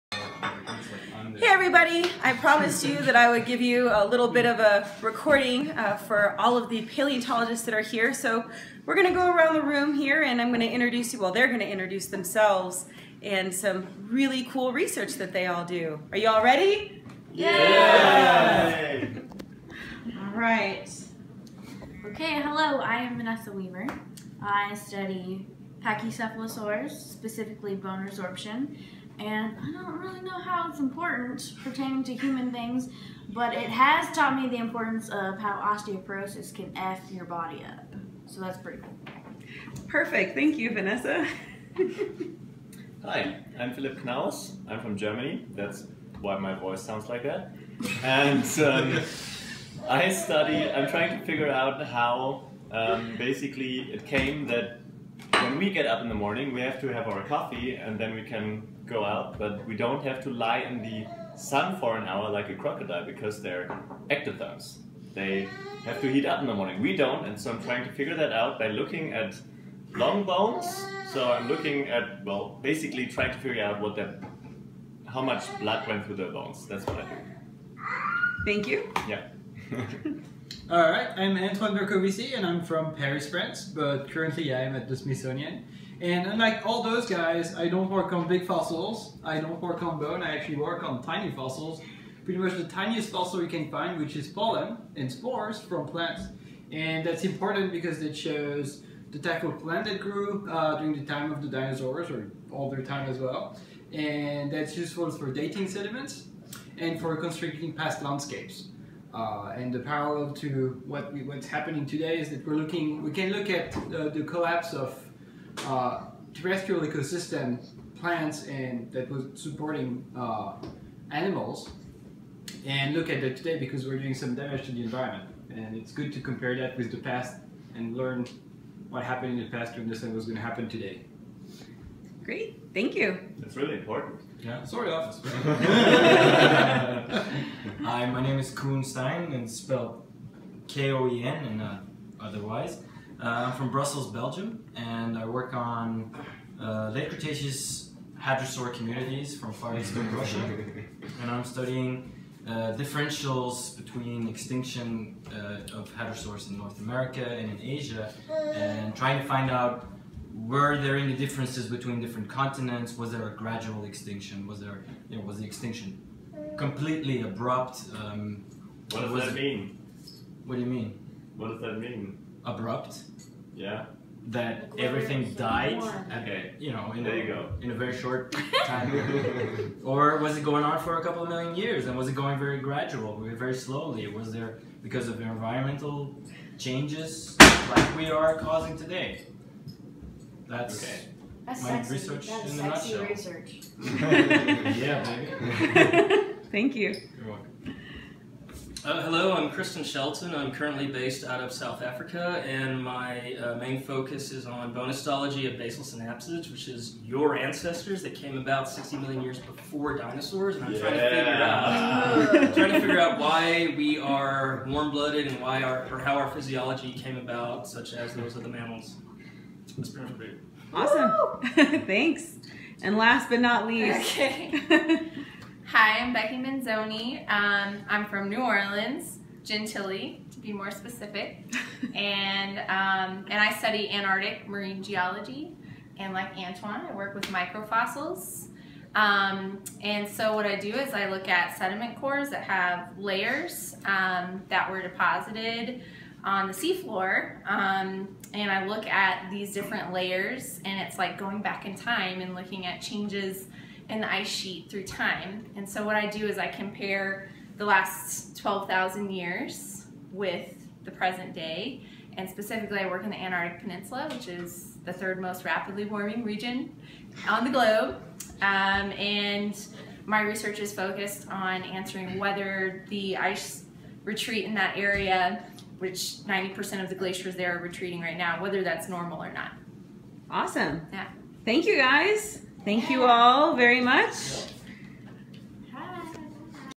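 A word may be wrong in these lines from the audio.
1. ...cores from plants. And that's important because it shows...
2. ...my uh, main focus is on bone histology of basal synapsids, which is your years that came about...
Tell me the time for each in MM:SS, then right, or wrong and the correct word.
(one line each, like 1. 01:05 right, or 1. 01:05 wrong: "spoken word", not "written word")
1. 01:35 wrong: "spores", not "cores"
2. 03:22 wrong: "ancestors", not "years".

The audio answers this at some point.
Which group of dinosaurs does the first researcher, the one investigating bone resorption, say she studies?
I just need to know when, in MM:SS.
00:25.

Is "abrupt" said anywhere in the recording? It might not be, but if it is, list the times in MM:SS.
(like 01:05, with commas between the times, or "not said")
02:47, 02:52.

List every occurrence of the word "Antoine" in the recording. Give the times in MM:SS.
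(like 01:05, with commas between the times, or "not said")
01:21, 03:56.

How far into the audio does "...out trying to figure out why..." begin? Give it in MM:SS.
03:31.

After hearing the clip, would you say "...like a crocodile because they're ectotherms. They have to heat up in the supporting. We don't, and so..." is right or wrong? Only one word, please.
wrong.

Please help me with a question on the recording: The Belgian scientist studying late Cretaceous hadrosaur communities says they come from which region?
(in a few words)
Far Eastern Russia.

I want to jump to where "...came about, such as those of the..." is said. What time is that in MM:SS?
03:36.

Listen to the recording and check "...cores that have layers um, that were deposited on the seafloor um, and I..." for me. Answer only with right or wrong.
right.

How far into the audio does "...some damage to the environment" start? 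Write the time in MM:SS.
02:04.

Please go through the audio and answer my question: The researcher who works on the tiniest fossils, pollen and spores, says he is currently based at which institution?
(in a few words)
The Smithsonian.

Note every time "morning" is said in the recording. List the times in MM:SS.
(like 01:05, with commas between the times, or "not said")
00:56, 01:06.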